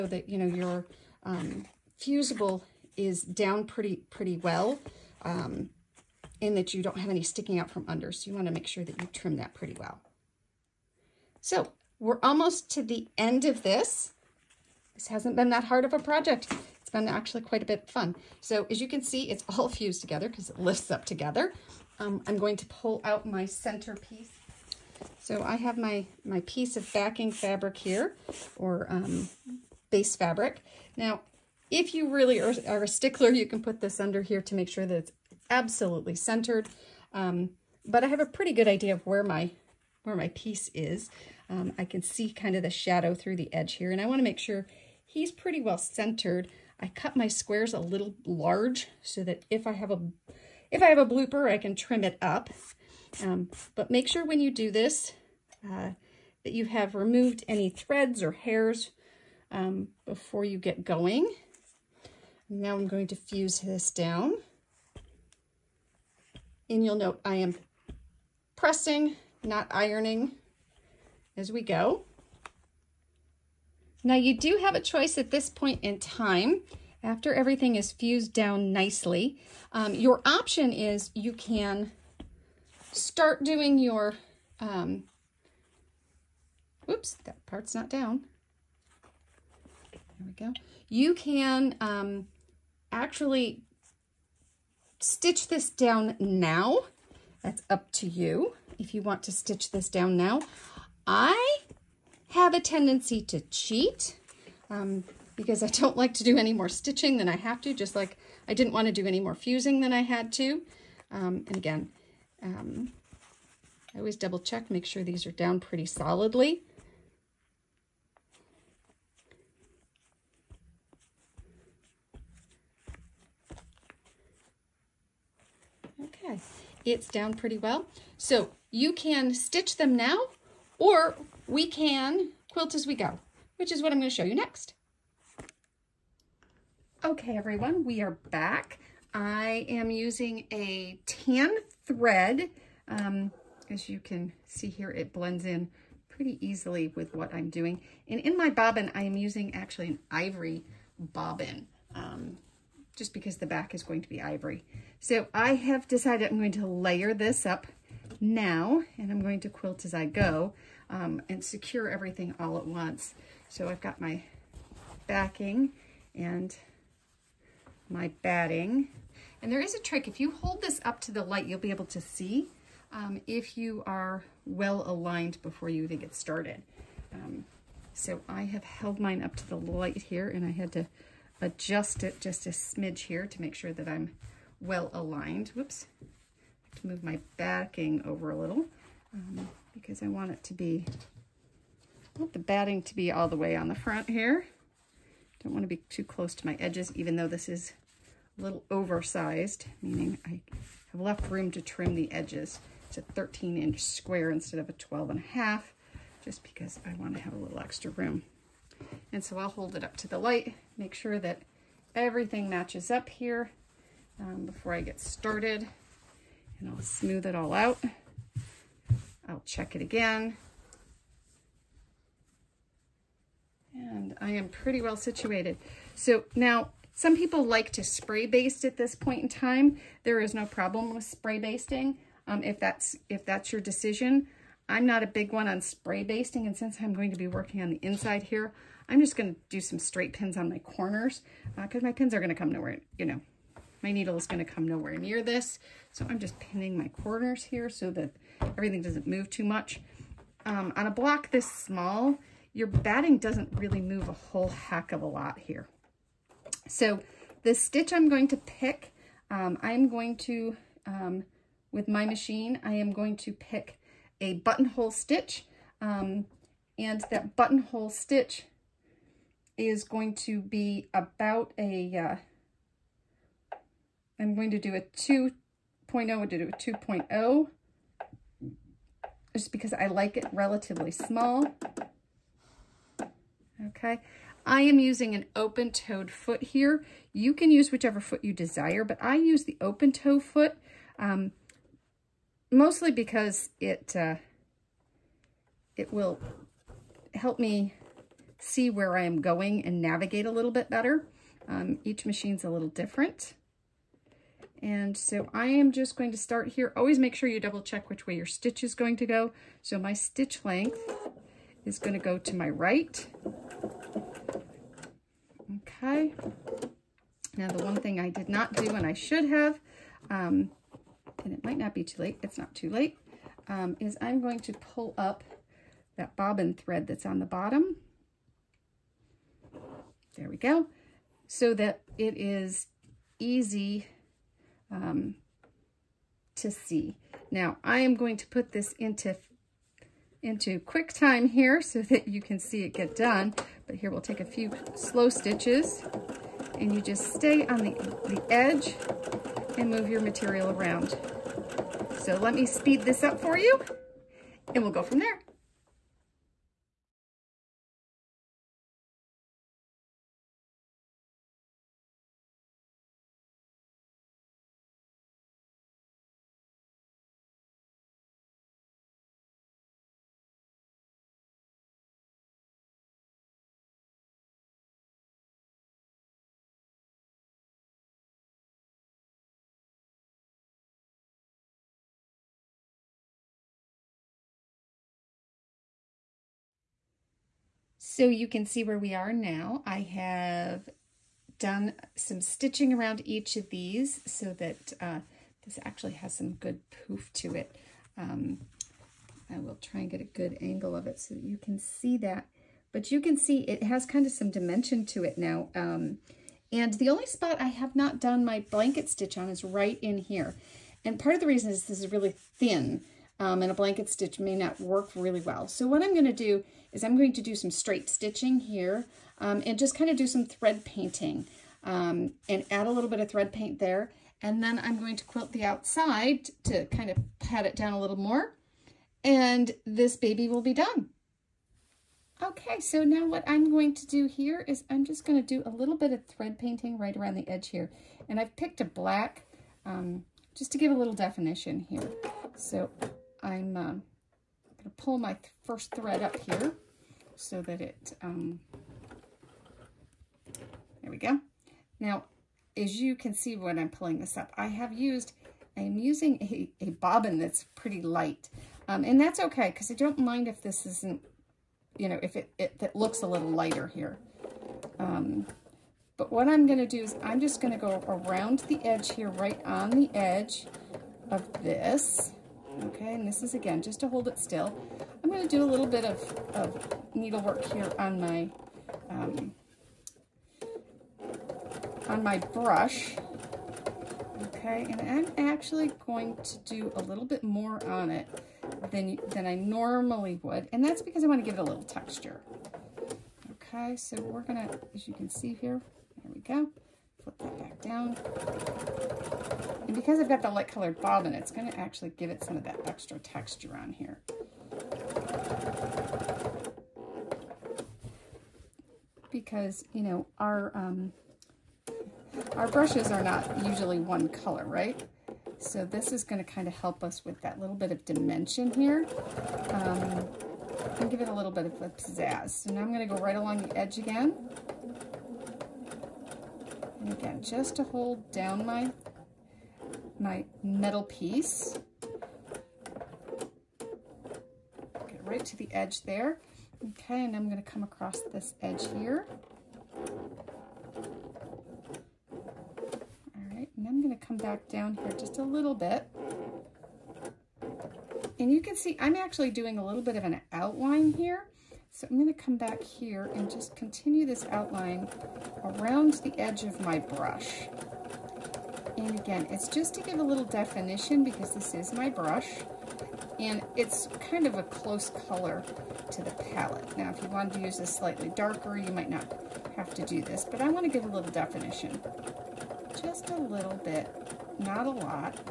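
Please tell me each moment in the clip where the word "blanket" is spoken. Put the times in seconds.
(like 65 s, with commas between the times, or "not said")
408 s, 413 s.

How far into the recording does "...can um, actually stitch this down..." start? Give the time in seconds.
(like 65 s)
91 s.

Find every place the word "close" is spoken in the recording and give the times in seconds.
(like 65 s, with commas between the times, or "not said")
196 s, 564 s.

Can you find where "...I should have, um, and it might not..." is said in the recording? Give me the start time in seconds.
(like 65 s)
318 s.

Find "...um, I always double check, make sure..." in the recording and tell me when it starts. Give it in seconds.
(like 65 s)
112 s.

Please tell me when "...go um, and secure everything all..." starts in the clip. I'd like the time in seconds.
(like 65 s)
160 s.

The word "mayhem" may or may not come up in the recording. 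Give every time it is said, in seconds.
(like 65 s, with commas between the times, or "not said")
not said.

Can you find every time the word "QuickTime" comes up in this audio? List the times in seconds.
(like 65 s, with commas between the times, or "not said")
340 s.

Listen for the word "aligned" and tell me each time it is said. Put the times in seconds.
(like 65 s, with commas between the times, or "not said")
174 s, 184 s.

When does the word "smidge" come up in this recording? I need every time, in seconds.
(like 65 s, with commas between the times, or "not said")
182 s.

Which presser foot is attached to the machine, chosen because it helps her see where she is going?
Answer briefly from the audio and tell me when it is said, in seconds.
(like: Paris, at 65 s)
open-toed foot, at 285 s.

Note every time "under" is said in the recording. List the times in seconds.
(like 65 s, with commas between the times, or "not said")
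7 s, 34 s.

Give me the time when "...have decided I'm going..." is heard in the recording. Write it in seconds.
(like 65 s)
155 s.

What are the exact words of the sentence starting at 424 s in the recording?
And then I'm going to quilt the outside to kind of pat it down a little more.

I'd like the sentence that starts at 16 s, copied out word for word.
It's been actually quite a bit fun.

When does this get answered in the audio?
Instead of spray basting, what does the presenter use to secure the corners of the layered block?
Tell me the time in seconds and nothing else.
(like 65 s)
239 s.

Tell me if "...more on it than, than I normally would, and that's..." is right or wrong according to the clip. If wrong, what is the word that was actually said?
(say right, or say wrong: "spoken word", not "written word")
right.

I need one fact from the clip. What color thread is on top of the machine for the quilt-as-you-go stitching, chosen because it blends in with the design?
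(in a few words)
tan.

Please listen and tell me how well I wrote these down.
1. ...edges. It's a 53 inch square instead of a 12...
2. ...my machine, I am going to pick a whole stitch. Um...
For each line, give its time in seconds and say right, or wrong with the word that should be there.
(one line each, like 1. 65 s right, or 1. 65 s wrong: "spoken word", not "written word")
1. 202 s wrong: "13", not "53"
2. 261 s wrong: "buttonhole", not "whole".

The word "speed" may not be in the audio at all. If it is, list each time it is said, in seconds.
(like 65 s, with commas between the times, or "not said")
352 s.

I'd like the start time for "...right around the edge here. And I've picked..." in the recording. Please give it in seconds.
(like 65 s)
436 s.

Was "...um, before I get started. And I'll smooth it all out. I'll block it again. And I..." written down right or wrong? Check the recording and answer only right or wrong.
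wrong.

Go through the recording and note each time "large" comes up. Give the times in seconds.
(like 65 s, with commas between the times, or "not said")
48 s.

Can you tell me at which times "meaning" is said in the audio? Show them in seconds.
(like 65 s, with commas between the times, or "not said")
199 s.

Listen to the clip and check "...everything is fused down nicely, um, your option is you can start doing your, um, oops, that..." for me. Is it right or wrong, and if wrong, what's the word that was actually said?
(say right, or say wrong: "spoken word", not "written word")
right.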